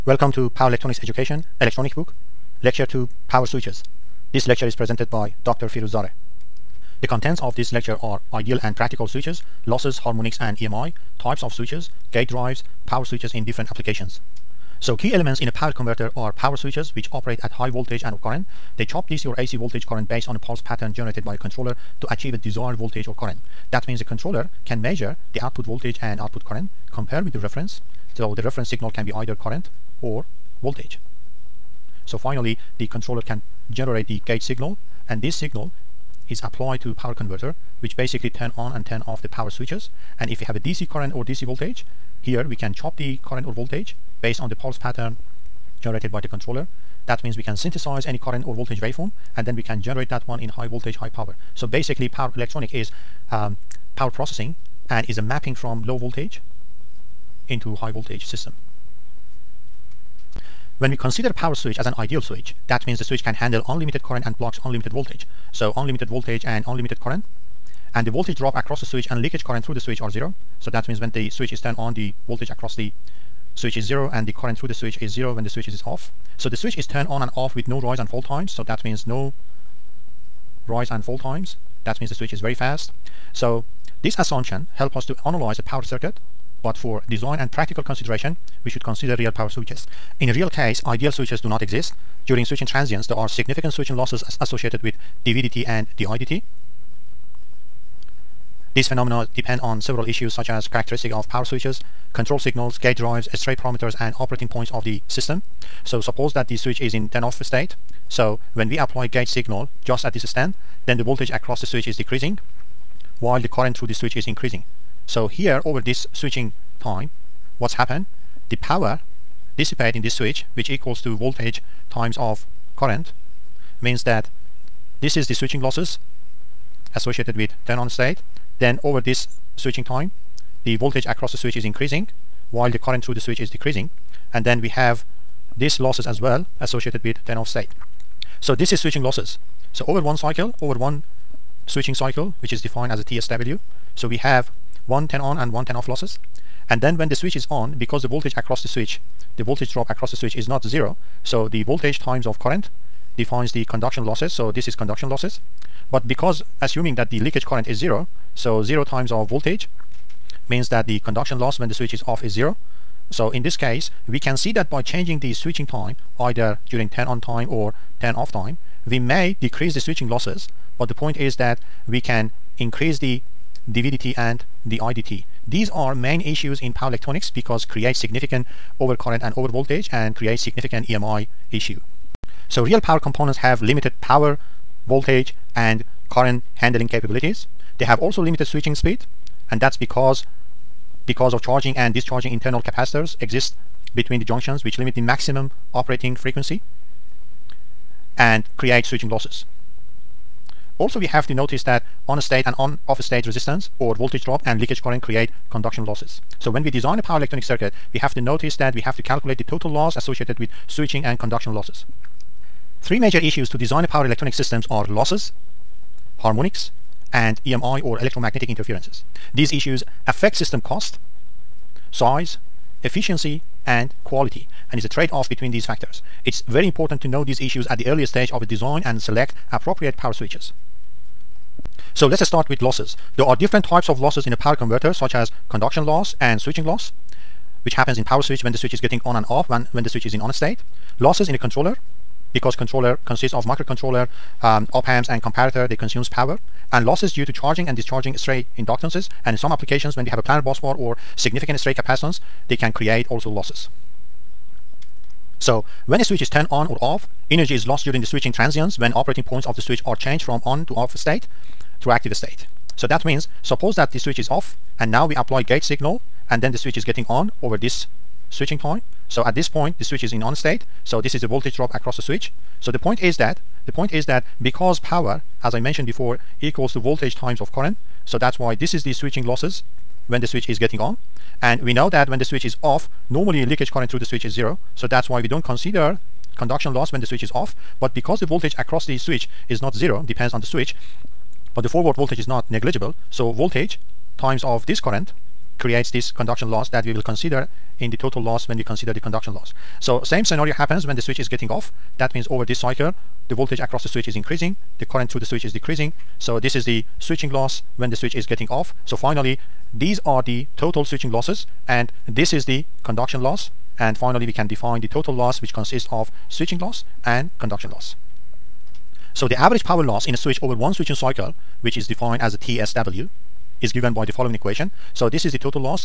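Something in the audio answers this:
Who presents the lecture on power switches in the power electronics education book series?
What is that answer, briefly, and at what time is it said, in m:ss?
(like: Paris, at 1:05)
Dr. Firuz Zare, at 0:05.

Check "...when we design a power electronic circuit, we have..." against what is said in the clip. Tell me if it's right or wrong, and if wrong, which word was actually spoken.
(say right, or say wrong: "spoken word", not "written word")
right.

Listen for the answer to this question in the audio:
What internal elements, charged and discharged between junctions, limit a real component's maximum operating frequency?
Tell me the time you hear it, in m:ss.
3:12.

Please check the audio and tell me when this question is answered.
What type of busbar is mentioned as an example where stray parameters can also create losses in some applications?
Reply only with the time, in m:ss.
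4:10.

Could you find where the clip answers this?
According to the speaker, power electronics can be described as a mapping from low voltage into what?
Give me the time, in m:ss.
0:57.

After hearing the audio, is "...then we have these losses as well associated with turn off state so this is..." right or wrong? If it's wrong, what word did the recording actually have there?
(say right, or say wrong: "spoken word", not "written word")
right.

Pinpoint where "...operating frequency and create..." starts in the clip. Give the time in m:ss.
3:15.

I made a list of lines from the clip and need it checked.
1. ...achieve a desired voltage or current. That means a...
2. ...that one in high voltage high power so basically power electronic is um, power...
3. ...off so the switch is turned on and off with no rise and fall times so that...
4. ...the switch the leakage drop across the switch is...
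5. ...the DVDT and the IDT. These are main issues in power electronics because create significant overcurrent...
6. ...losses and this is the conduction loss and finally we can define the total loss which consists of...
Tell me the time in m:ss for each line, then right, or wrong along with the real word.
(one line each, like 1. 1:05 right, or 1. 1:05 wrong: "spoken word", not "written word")
1. 0:22 right
2. 0:50 right
3. 1:15 right
4. 2:28 wrong: "voltage", not "leakage"
5. 2:52 right
6. 5:11 right.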